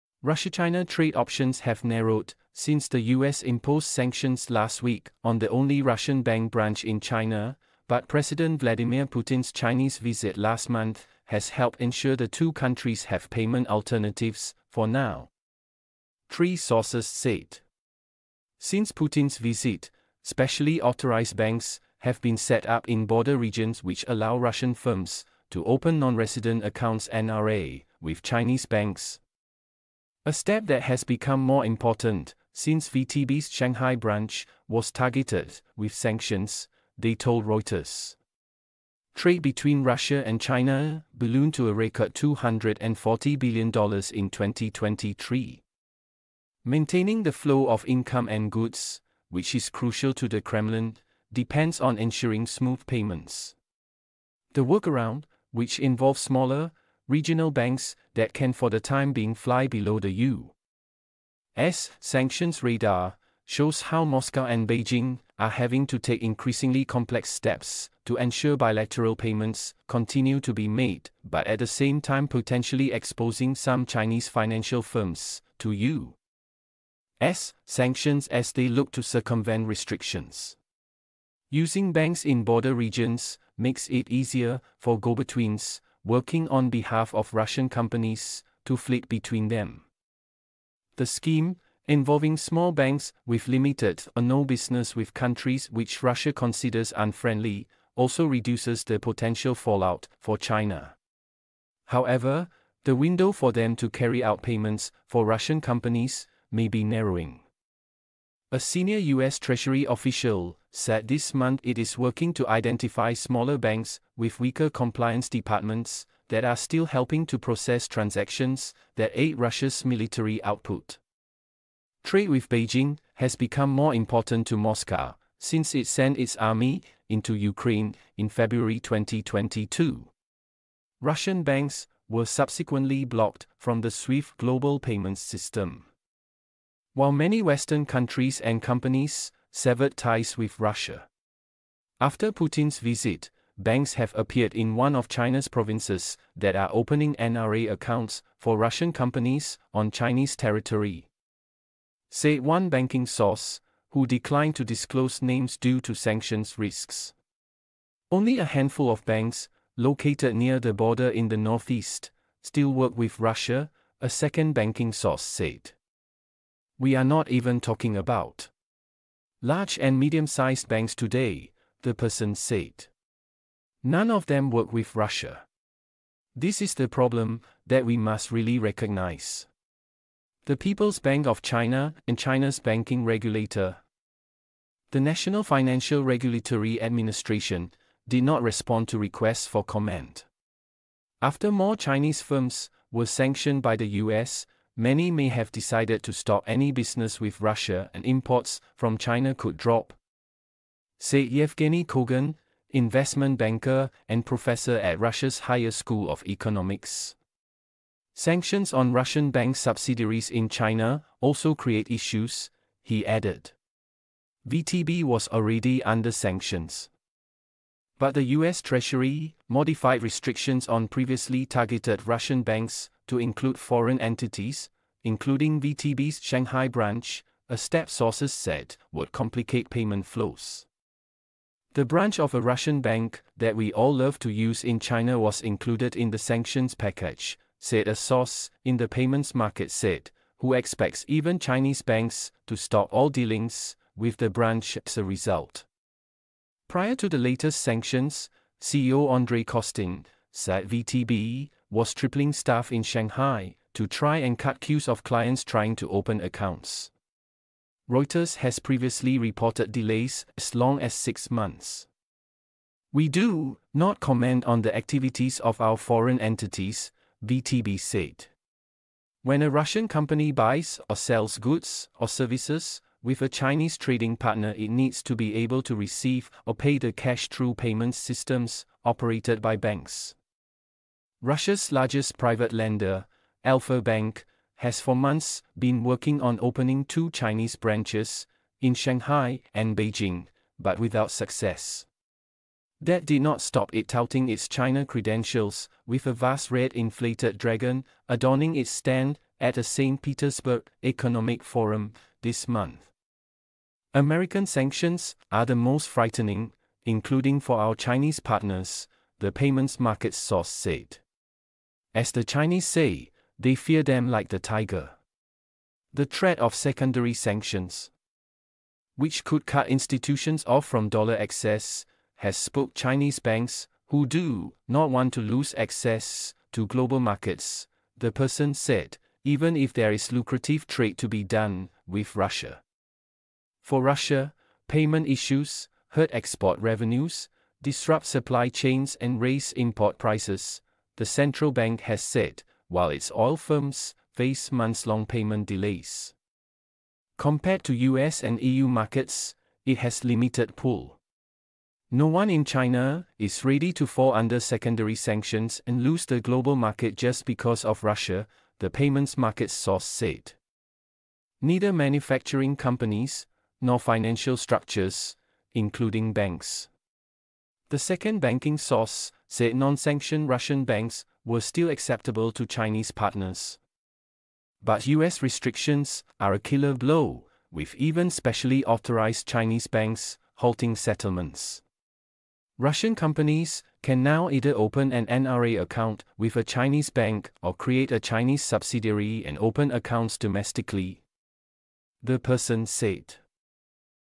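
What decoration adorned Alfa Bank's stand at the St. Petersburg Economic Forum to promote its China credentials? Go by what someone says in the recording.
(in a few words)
red inflated dragon.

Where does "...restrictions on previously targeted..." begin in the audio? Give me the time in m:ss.
3:40.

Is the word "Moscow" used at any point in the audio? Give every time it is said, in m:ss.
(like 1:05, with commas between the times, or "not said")
1:04, 2:04.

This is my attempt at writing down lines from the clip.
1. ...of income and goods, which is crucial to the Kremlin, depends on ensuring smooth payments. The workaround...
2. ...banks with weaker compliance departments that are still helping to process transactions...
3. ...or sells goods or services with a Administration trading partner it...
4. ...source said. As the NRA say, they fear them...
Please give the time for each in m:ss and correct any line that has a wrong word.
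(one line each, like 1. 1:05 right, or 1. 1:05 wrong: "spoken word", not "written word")
1. 0:47 right
2. 1:53 right
3. 4:30 wrong: "Chinese", not "Administration"
4. 5:10 wrong: "Chinese", not "NRA".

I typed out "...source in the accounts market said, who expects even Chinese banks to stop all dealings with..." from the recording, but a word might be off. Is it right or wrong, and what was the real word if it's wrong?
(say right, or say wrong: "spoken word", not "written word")
wrong: "payments", not "accounts".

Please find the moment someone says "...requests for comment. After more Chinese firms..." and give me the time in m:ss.
3:08.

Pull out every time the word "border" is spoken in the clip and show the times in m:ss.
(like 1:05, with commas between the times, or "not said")
0:23, 1:22, 2:40.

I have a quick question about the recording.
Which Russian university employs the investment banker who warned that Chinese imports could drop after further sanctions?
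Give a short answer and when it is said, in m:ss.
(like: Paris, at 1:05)
Higher School of Economics, at 3:25.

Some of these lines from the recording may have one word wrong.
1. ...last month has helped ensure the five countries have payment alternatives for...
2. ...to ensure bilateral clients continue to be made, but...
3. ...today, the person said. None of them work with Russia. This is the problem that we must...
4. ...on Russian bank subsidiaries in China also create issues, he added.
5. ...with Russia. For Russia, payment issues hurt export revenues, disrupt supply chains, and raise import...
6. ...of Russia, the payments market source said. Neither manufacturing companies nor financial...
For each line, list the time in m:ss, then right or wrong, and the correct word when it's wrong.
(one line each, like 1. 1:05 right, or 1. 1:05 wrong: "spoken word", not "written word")
1. 0:10 wrong: "two", not "five"
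2. 1:08 wrong: "payments", not "clients"
3. 2:50 right
4. 3:28 right
5. 5:31 right
6. 5:57 right.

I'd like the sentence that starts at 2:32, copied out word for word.
Said one banking source, who declined to disclose names due to sanctions risks.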